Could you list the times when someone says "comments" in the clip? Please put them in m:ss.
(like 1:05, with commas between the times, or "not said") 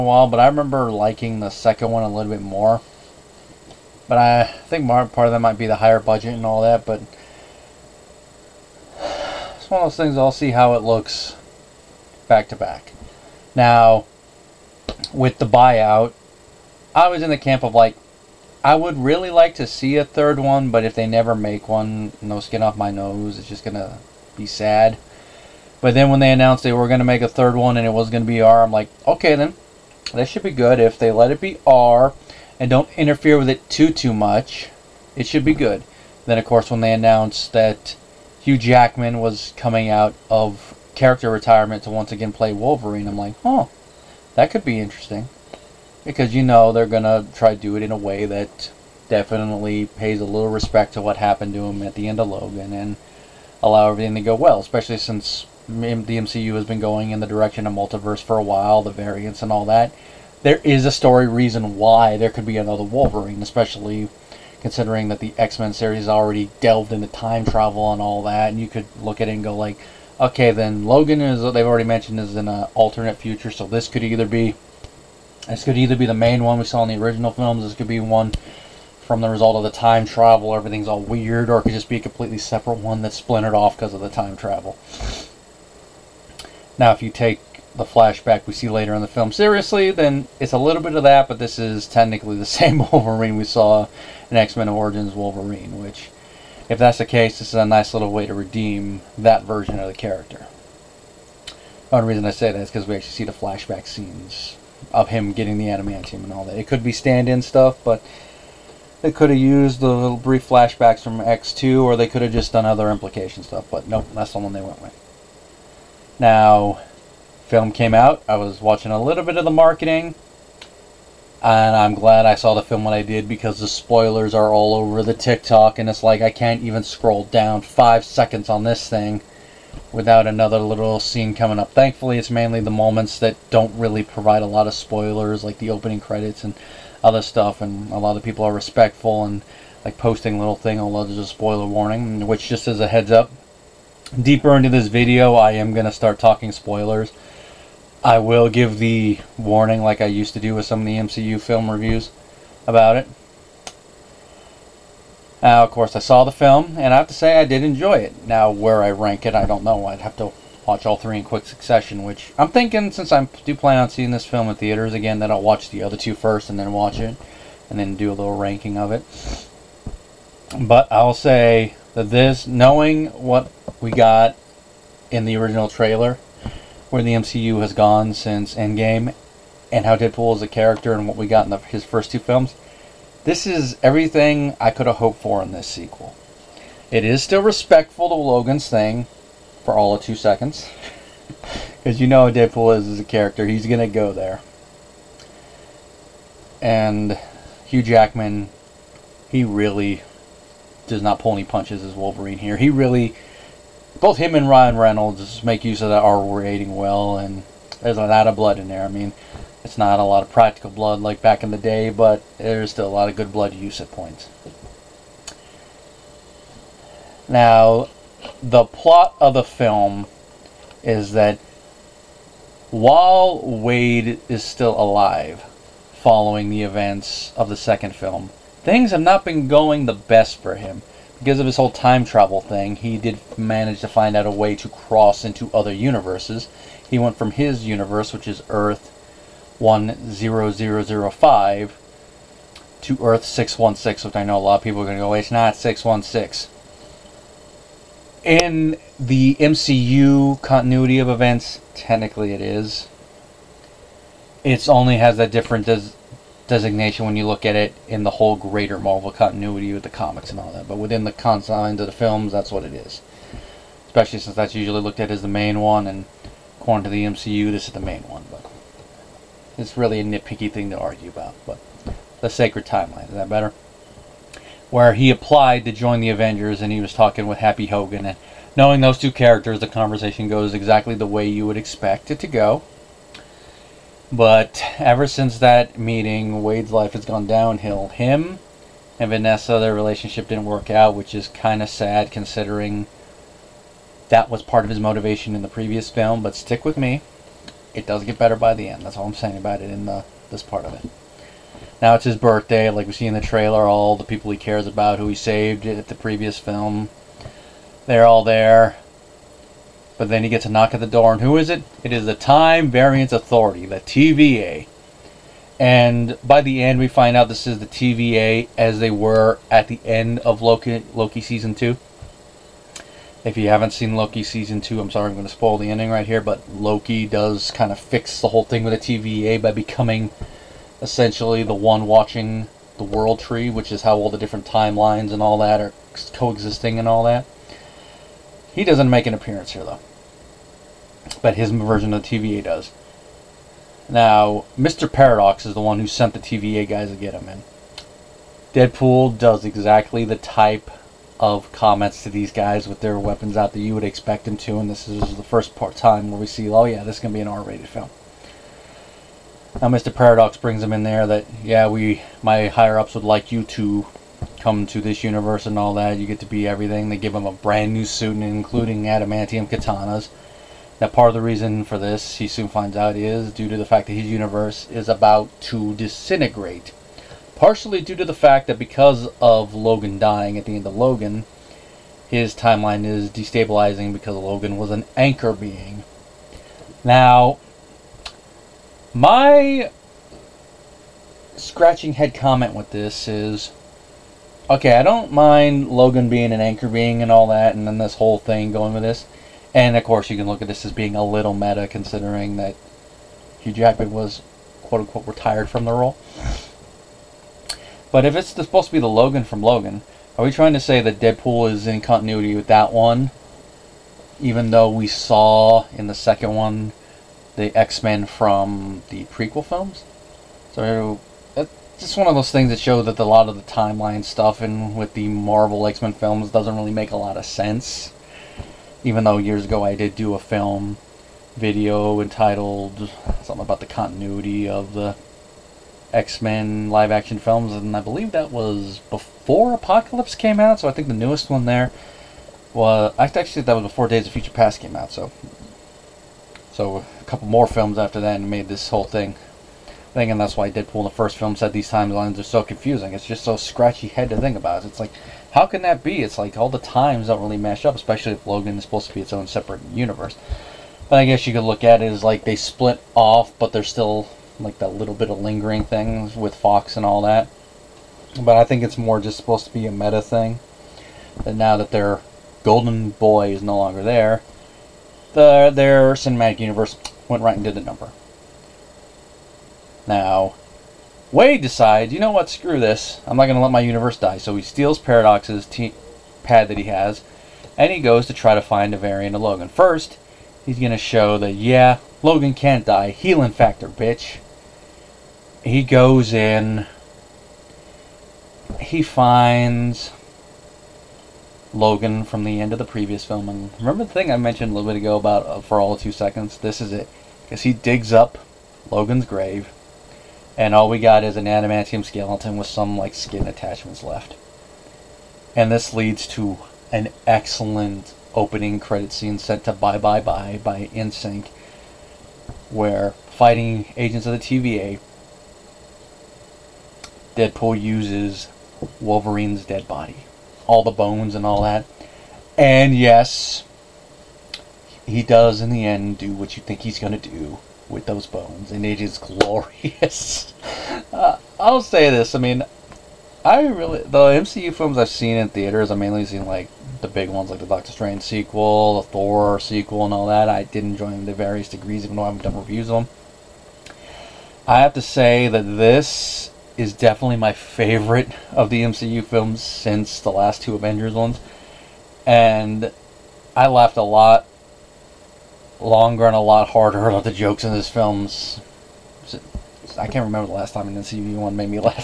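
5:51, 6:32.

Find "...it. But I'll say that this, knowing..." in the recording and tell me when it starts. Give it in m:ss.
2:48.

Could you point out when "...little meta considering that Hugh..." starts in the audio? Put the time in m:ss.
6:41.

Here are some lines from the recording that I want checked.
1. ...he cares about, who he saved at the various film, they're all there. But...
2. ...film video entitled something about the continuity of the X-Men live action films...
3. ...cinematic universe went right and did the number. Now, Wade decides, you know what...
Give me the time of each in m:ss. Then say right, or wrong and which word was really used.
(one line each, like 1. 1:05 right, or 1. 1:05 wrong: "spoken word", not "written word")
1. 5:04 wrong: "previous", not "various"
2. 7:10 right
3. 7:55 right.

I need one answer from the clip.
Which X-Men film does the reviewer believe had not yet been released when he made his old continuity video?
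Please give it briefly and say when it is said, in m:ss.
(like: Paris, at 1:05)
Days of Future Past, at 7:23.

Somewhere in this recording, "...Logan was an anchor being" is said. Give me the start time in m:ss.
6:24.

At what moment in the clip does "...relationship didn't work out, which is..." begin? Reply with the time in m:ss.
4:49.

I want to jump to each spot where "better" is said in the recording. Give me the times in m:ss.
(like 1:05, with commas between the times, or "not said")
4:33, 4:58.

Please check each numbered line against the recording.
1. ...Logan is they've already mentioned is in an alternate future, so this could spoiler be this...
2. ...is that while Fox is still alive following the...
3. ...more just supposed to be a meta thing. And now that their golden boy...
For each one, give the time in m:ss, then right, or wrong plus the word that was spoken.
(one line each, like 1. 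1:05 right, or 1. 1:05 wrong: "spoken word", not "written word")
1. 1:10 wrong: "either", not "spoiler"
2. 3:40 wrong: "Wade", not "Fox"
3. 7:48 right.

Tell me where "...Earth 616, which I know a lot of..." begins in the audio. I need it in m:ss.
4:03.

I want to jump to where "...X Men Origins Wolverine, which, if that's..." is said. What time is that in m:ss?
1:34.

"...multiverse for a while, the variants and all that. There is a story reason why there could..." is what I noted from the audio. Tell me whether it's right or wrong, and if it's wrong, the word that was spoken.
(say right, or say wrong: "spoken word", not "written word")
right.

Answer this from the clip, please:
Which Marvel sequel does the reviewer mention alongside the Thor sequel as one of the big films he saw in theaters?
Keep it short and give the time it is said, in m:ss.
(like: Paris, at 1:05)
Doctor Strange sequel, at 9:07.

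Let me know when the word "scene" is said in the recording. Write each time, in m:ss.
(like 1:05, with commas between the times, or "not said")
1:43, 2:10, 8:38.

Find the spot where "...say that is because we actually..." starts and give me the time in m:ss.
1:42.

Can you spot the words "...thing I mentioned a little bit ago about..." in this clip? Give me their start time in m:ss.
8:23.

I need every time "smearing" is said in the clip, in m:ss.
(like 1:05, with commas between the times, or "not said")
not said.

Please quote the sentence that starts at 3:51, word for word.
Because of his whole time travel thing, he did manage to find out a way to cross into other universes.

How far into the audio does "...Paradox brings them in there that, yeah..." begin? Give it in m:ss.
5:59.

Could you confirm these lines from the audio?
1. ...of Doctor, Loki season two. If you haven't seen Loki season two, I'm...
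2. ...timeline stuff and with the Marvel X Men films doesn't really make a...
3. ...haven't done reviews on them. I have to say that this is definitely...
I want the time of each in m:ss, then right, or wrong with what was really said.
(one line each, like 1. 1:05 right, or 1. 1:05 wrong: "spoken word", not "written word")
1. 5:20 wrong: "Loki", not "Doctor"
2. 7:03 right
3. 9:12 right.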